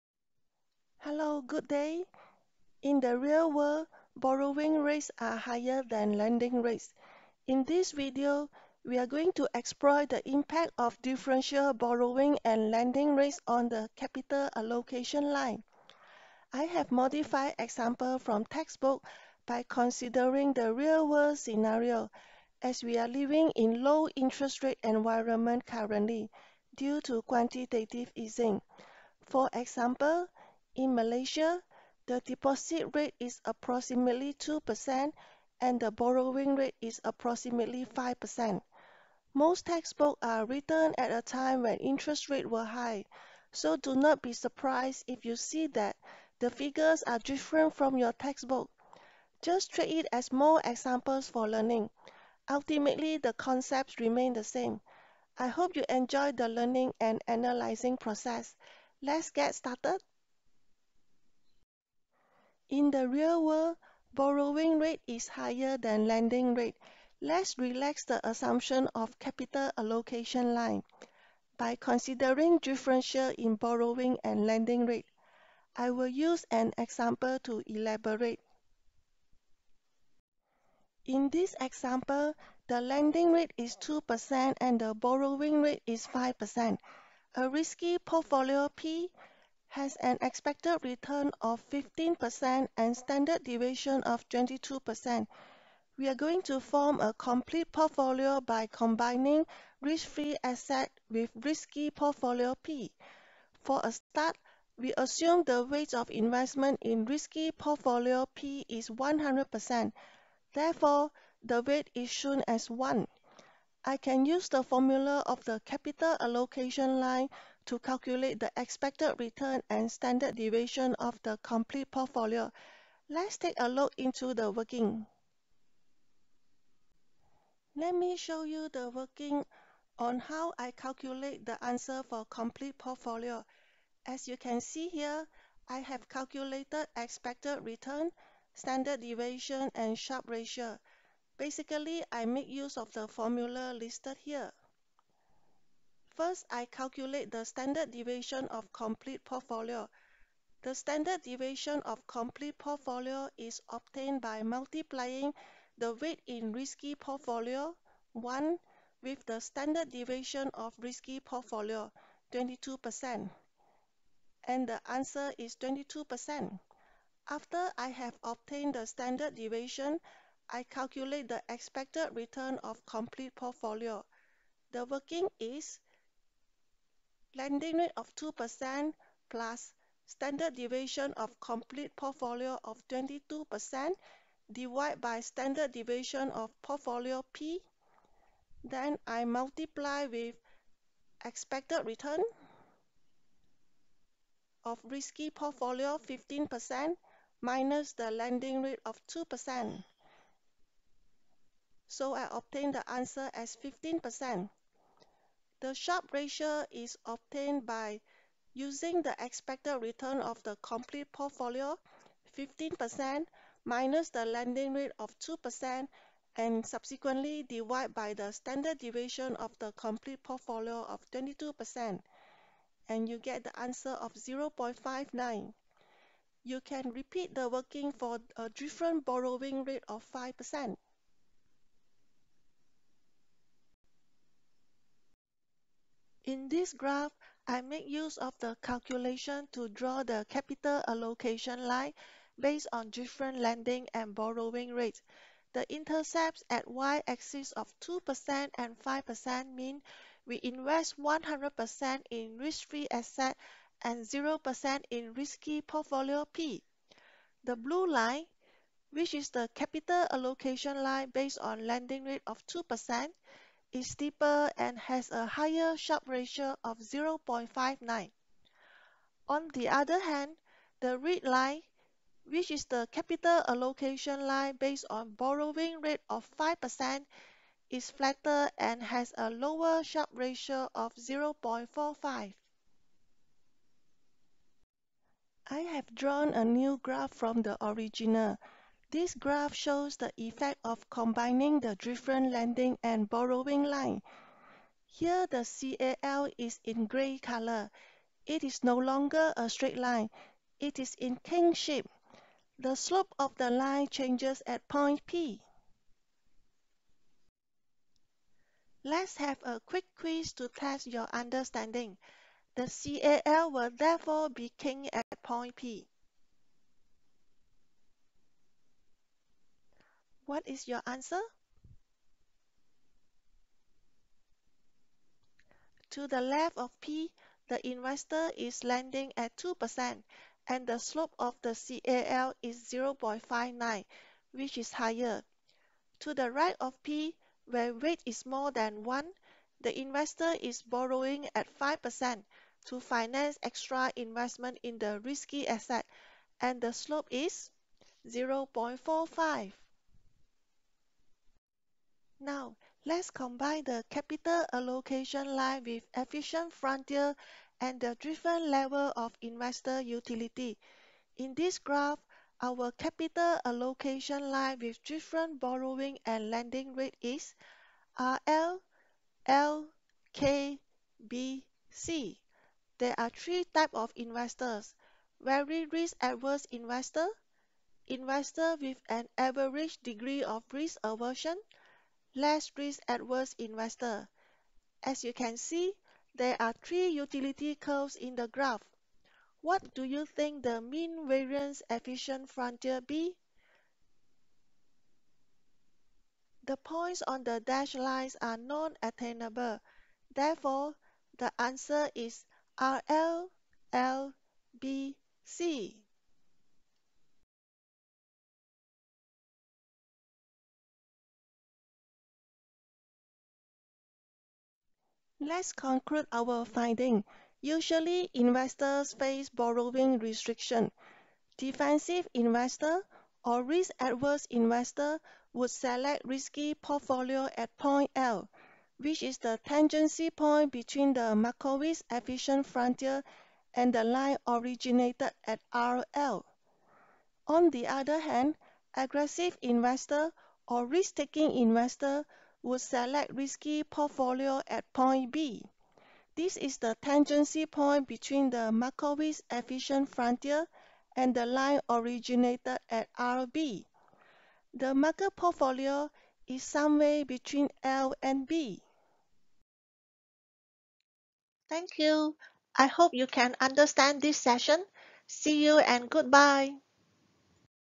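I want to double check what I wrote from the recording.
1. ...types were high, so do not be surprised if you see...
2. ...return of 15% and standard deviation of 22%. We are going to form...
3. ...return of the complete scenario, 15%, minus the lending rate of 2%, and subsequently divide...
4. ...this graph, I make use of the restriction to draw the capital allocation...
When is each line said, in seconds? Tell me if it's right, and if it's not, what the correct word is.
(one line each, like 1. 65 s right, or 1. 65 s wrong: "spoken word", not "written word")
1. 42 s wrong: "rates", not "types"
2. 90 s right
3. 209 s wrong: "portfolio", not "scenario"
4. 236 s wrong: "calculation", not "restriction".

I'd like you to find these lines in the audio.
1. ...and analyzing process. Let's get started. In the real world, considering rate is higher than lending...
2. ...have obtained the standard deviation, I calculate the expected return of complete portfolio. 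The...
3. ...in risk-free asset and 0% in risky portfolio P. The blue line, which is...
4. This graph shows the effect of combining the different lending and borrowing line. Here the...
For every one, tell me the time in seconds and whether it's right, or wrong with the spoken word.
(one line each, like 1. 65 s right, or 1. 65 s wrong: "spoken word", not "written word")
1. 57 s wrong: "borrowing", not "considering"
2. 167 s right
3. 252 s right
4. 288 s right.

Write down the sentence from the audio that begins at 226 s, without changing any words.
You can repeat the working for a different borrowing rate of 5%.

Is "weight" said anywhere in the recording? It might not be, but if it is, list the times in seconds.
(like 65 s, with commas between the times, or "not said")
105 s, 111 s, 155 s, 337 s.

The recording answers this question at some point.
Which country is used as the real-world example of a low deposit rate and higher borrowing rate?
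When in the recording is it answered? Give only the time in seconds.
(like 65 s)
30 s.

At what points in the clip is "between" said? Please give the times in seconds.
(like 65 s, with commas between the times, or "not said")
430 s, 447 s, 457 s.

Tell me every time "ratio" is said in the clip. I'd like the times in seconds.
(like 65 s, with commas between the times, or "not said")
140 s, 206 s, 266 s, 280 s.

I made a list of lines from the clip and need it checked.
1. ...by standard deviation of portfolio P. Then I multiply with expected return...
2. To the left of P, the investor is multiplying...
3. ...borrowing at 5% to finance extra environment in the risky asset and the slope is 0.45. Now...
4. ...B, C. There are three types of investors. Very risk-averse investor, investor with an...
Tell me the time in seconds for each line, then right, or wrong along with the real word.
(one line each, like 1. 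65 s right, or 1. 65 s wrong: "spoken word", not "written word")
1. 184 s right
2. 325 s wrong: "lending", not "multiplying"
3. 340 s wrong: "investment", not "environment"
4. 371 s right.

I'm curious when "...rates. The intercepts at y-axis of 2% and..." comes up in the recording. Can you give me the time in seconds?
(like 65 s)
244 s.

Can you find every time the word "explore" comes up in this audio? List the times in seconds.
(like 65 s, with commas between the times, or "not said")
9 s.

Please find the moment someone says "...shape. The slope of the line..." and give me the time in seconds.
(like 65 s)
301 s.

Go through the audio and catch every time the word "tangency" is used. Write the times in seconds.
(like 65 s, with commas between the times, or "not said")
429 s, 446 s.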